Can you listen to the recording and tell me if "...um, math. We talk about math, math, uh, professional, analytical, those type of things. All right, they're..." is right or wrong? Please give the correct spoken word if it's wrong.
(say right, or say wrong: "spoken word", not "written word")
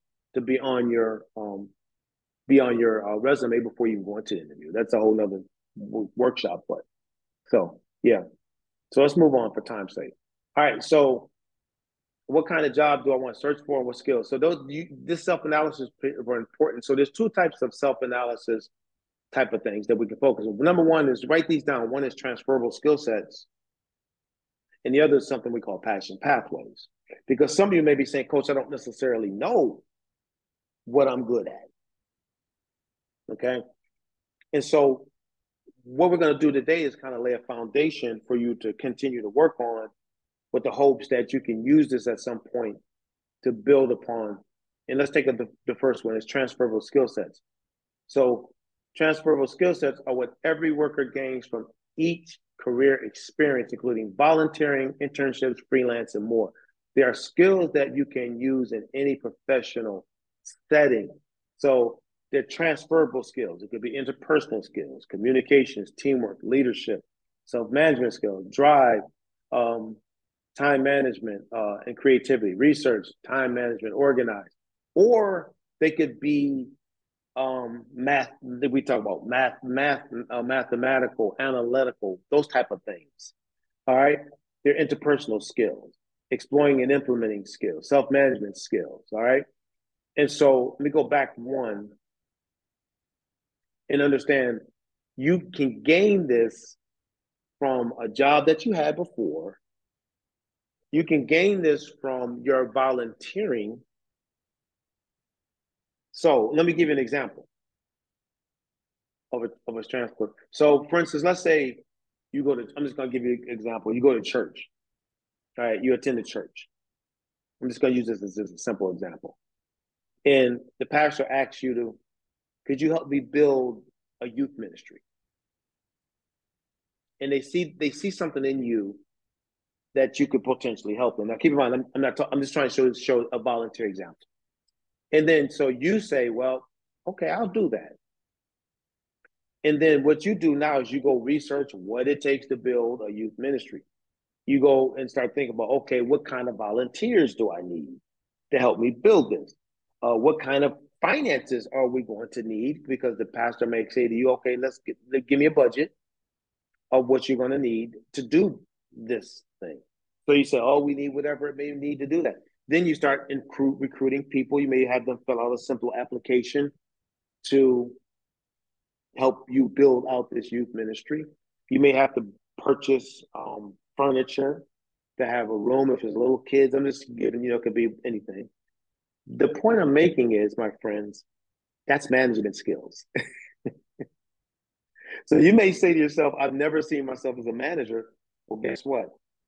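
wrong: "mathematical", not "professional".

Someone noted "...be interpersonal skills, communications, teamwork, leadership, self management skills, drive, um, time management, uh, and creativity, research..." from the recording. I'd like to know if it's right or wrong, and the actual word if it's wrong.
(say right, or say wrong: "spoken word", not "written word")
right.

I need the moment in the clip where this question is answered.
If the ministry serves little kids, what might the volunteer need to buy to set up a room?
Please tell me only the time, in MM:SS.
02:53.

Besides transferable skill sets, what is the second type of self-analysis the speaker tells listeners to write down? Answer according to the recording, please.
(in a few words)
Passion pathways.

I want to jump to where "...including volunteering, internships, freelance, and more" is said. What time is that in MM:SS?
00:53.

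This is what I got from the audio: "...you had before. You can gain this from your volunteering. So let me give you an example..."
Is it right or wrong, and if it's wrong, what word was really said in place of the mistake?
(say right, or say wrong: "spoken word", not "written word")
right.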